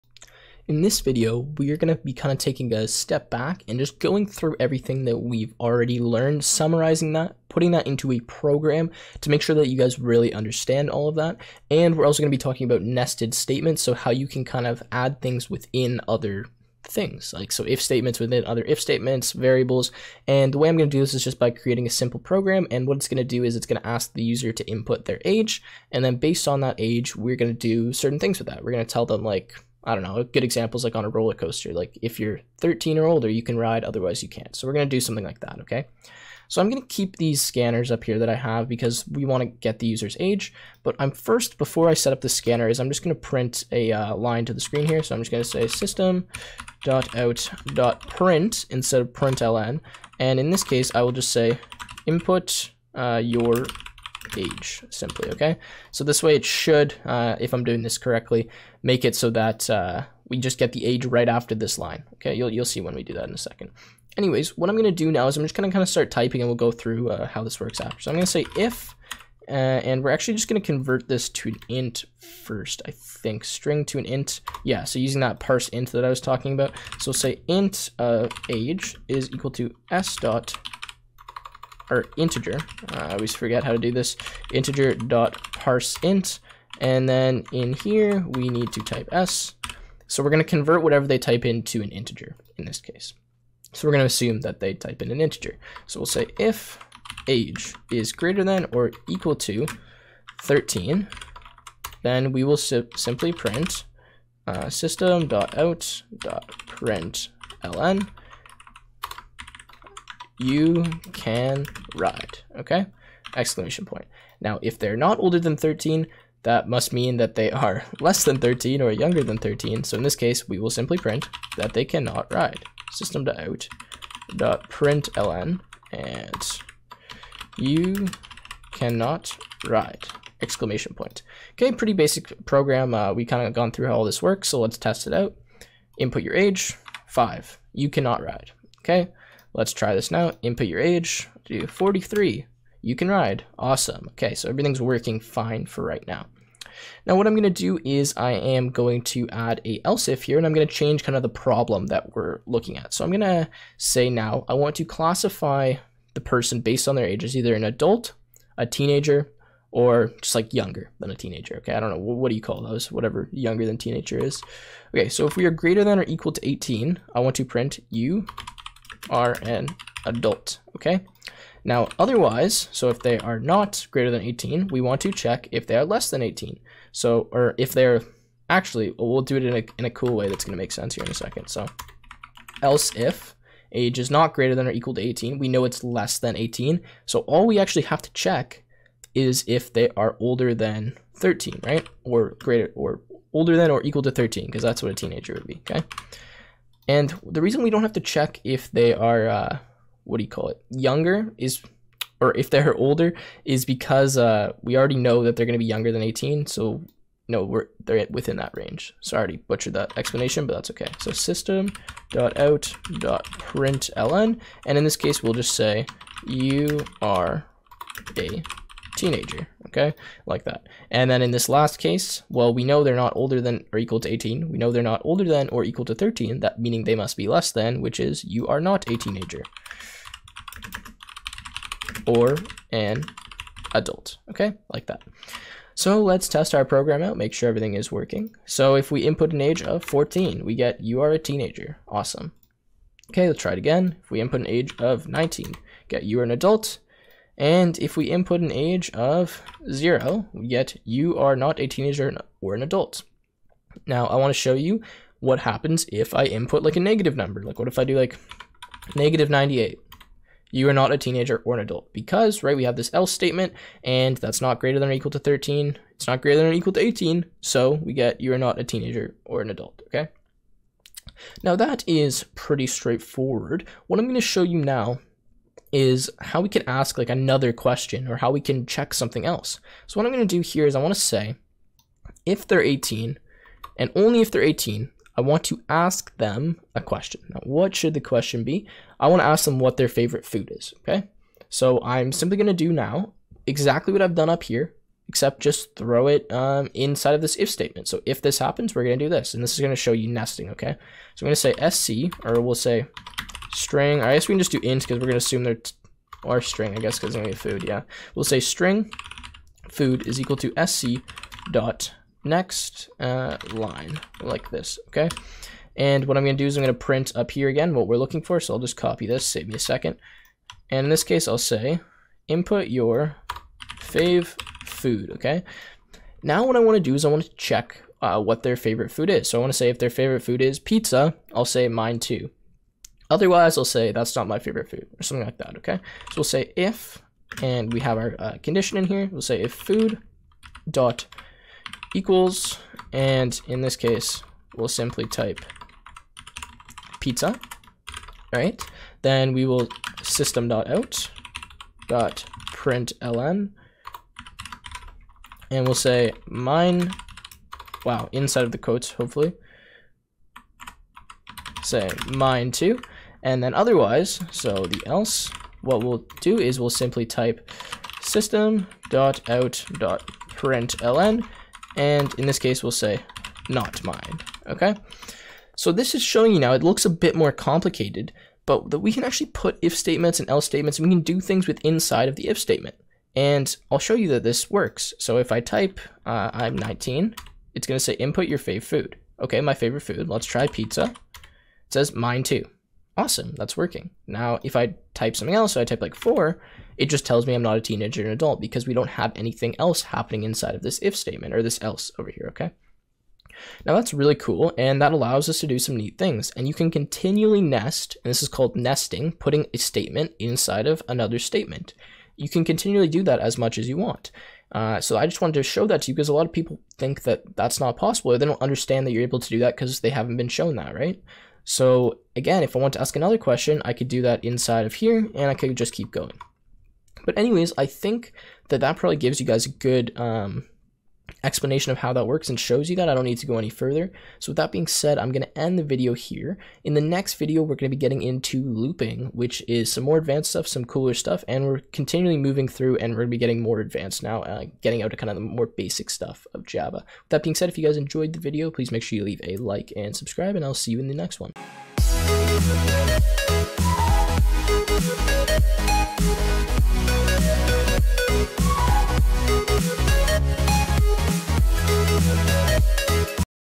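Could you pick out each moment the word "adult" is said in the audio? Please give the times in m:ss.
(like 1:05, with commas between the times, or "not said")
2:37, 2:50, 3:53, 4:06, 4:12, 4:21, 4:29, 6:38.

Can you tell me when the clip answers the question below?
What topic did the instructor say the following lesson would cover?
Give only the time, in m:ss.
7:18.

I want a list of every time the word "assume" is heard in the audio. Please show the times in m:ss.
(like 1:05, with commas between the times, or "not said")
1:34, 5:05.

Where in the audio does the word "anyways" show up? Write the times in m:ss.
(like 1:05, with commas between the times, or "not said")
1:04, 7:07.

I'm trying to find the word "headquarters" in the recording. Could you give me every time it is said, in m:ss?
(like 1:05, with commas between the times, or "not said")
not said.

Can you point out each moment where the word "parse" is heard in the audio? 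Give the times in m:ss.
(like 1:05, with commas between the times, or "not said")
1:15, 1:25.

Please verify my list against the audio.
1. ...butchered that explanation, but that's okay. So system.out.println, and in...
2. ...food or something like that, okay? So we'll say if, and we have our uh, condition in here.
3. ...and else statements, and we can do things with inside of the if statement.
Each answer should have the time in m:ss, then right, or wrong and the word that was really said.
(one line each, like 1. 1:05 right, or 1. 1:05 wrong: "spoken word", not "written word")
1. 3:29 right
2. 5:34 right
3. 6:20 right.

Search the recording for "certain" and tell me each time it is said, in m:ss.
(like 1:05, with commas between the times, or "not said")
0:27.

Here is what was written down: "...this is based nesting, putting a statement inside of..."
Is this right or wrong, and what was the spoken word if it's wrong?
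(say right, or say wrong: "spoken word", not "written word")
wrong: "called", not "based".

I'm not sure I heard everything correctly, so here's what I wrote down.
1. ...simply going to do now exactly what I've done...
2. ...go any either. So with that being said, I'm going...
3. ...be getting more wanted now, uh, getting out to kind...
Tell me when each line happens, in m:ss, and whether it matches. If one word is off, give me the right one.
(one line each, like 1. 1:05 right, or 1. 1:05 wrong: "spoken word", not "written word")
1. 4:52 right
2. 7:13 wrong: "further", not "either"
3. 7:23 wrong: "advanced", not "wanted".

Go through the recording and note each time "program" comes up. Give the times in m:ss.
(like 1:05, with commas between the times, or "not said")
0:08, 0:22, 2:12, 3:56.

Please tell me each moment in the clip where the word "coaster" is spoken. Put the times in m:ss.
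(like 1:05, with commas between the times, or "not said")
0:31.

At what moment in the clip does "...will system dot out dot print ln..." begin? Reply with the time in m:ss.
5:49.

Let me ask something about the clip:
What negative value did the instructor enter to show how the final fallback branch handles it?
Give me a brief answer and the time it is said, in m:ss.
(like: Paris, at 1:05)
-98, at 4:18.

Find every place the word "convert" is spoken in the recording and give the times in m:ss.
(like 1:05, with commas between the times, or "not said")
1:10, 1:30.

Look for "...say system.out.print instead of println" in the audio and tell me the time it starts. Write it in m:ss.
0:45.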